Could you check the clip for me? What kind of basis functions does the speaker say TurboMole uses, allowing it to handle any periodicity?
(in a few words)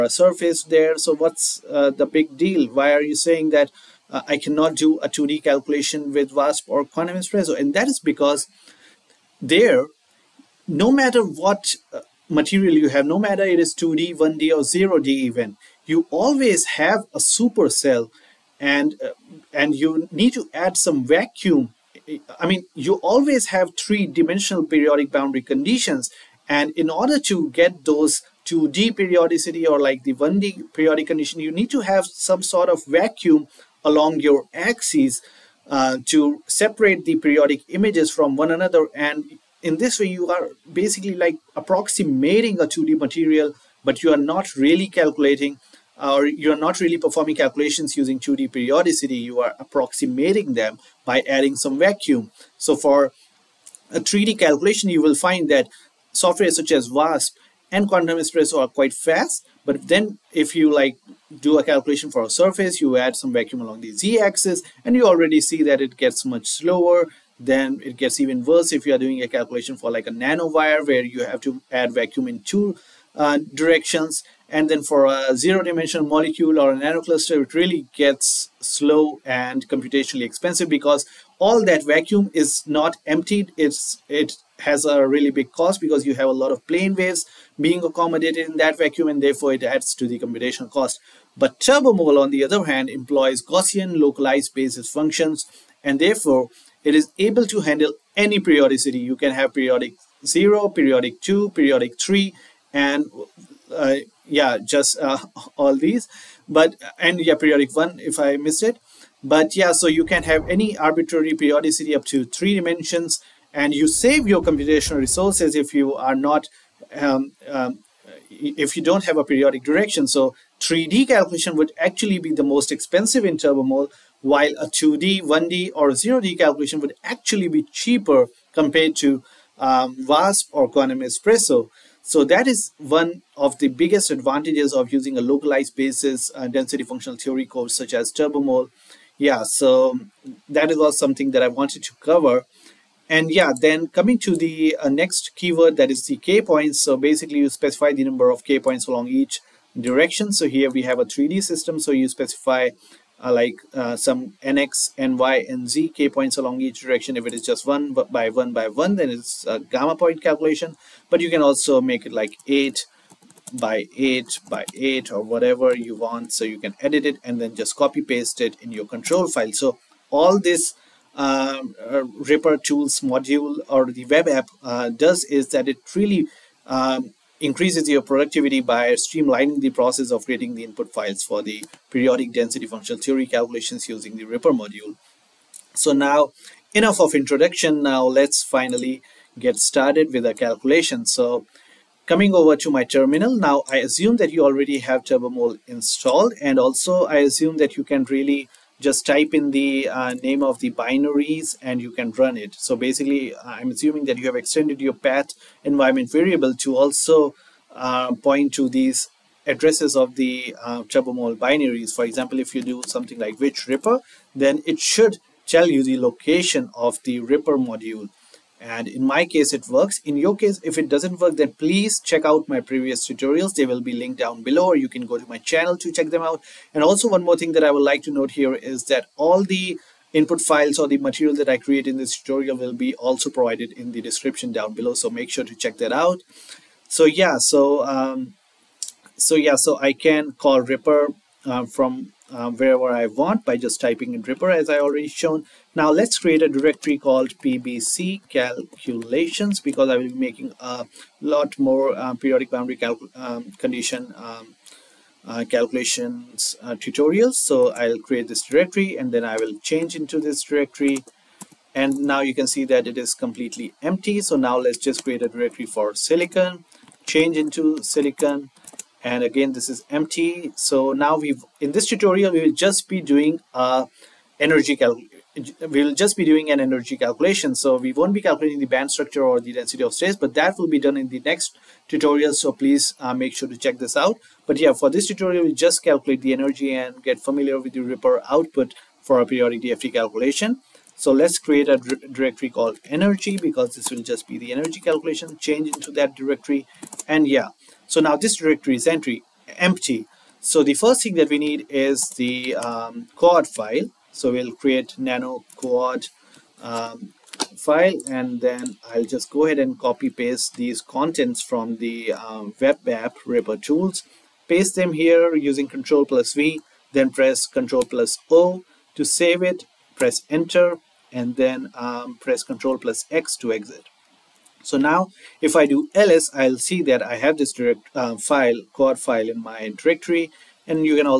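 Gaussian localized basis functions.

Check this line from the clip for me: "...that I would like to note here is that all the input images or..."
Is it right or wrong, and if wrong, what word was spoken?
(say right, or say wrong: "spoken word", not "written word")
wrong: "files", not "images".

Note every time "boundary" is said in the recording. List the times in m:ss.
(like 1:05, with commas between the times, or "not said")
0:25, 4:12.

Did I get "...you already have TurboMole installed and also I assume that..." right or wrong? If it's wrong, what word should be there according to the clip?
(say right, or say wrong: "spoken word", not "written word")
right.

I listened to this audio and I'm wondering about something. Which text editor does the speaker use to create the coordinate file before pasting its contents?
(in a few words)
nano.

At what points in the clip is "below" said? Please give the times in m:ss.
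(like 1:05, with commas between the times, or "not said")
3:44, 3:54.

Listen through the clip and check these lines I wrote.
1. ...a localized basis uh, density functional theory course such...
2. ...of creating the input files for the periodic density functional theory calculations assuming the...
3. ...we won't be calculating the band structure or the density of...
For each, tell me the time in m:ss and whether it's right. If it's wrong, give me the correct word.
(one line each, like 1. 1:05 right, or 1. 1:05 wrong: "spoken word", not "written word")
1. 2:15 right
2. 3:00 wrong: "using", not "assuming"
3. 4:37 right.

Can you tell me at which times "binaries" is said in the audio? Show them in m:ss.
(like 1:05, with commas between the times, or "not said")
3:20, 3:31.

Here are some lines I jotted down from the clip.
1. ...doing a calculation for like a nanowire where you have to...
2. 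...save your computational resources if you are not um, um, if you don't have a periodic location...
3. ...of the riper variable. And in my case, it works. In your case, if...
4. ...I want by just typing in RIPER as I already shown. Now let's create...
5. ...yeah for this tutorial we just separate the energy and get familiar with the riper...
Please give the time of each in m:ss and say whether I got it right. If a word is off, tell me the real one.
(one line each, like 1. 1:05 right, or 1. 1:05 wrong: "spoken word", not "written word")
1. 1:08 right
2. 1:53 wrong: "direction", not "location"
3. 3:36 wrong: "module", not "variable"
4. 4:02 right
5. 4:44 wrong: "calculate", not "separate".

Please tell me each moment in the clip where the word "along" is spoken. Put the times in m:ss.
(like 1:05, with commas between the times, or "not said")
0:33, 1:03, 2:28, 2:36.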